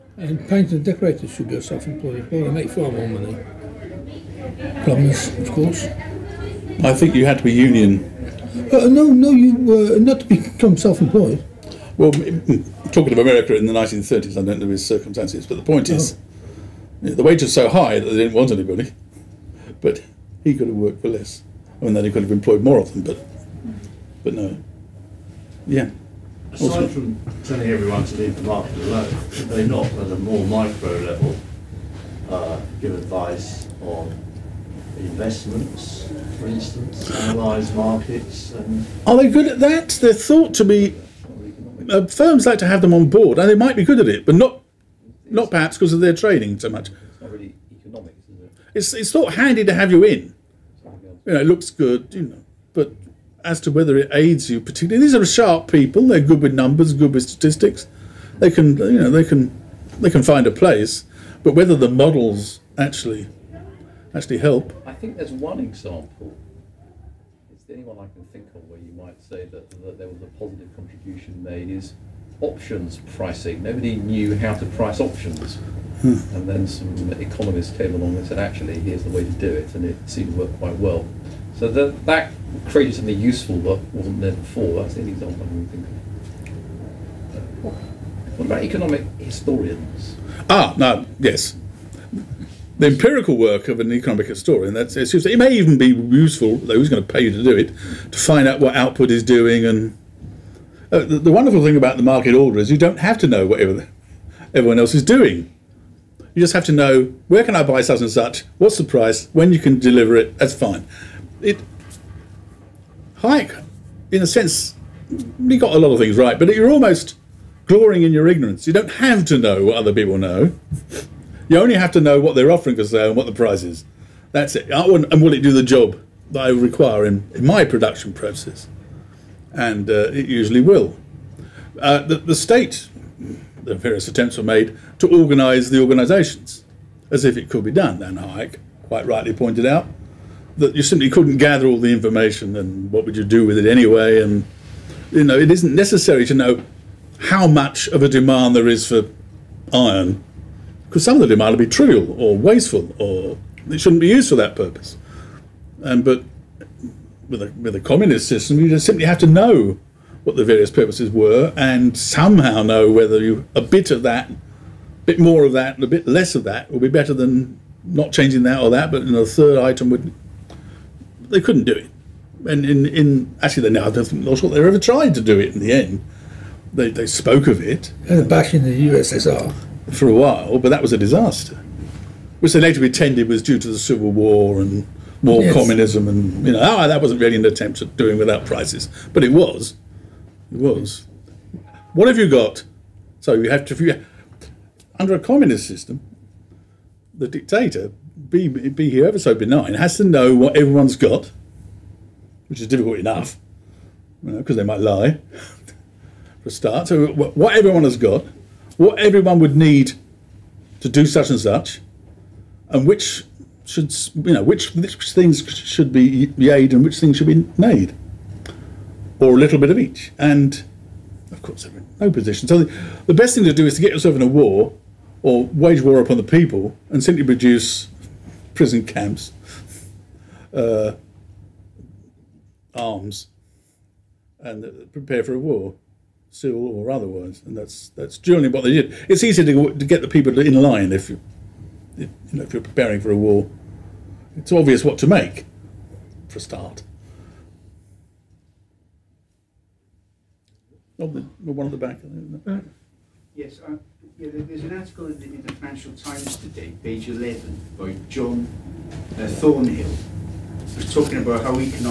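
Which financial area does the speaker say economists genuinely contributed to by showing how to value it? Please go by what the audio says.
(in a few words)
Options pricing.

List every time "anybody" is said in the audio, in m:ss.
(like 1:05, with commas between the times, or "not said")
0:18.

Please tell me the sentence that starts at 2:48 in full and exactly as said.
But in the third item would they couldn't do it.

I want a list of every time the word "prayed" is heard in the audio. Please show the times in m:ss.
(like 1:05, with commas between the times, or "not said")
not said.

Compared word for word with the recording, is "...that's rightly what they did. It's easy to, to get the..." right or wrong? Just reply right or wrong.
wrong.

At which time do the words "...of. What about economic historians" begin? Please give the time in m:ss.
1:25.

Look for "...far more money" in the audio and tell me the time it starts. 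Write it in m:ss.
0:02.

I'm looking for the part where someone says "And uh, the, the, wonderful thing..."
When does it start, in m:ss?
1:39.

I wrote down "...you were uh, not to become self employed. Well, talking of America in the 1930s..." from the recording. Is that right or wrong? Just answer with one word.
right.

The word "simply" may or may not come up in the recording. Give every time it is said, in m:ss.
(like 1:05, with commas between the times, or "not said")
2:20, 2:38, 3:47.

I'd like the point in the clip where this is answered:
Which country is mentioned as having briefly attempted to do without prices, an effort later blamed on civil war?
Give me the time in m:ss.
2:58.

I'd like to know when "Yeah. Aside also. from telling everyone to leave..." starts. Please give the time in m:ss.
0:25.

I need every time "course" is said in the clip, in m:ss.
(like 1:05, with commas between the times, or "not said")
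0:05, 3:41.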